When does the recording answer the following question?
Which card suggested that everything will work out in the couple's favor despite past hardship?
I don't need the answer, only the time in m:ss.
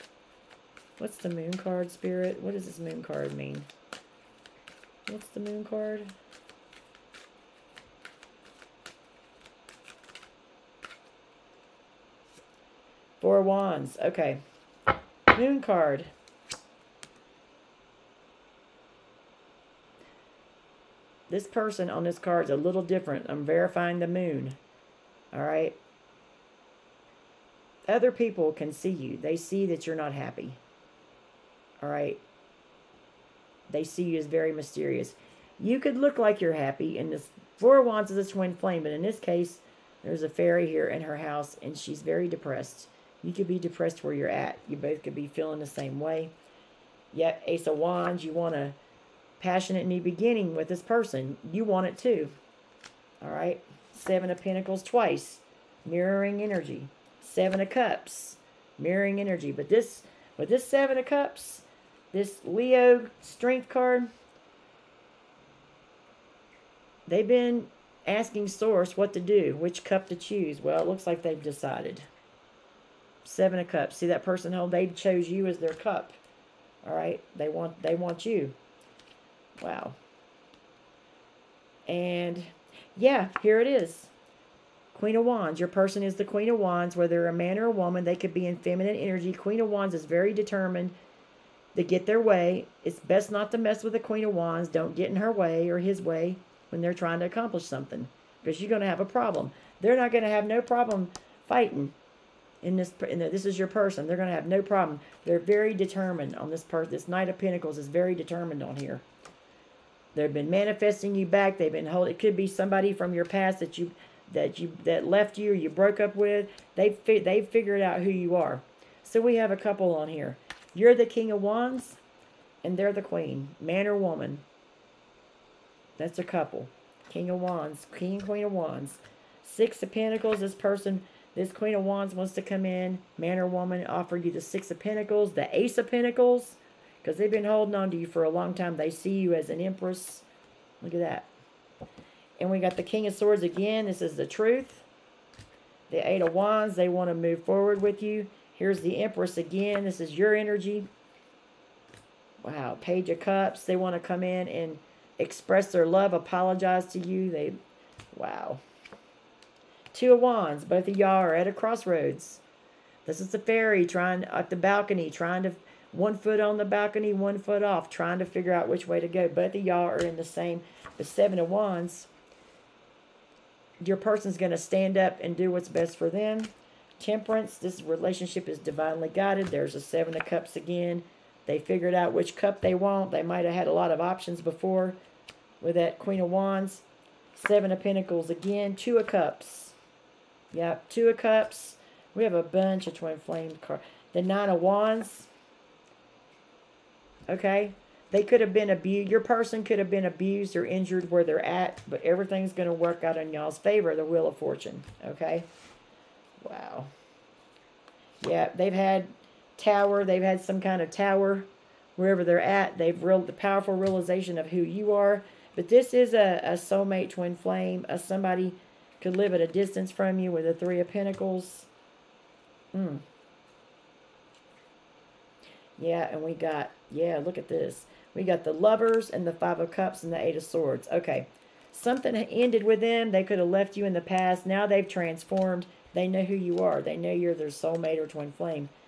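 3:23.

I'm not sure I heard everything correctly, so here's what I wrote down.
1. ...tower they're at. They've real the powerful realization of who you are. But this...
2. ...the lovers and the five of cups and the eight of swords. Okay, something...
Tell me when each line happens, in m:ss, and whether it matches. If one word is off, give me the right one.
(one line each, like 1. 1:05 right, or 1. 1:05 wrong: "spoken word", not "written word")
1. 3:31 wrong: "wherever", not "tower"
2. 3:48 right.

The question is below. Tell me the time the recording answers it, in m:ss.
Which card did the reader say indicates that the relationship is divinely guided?
2:56.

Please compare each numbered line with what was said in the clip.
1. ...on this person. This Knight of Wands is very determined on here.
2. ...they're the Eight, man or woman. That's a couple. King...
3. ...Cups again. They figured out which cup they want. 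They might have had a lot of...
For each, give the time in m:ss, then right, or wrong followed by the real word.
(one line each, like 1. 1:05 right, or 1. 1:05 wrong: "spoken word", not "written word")
1. 1:46 wrong: "Pentacles", not "Wands"
2. 2:02 wrong: "Queen", not "Eight"
3. 3:00 right.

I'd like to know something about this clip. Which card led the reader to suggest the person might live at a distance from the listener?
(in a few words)
Three of Pentacles.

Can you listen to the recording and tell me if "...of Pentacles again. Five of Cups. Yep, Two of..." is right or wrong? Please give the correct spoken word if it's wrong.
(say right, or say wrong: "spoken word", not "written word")
wrong: "Two", not "Five".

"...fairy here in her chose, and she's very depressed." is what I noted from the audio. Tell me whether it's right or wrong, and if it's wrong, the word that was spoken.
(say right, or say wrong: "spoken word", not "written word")
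wrong: "house", not "chose".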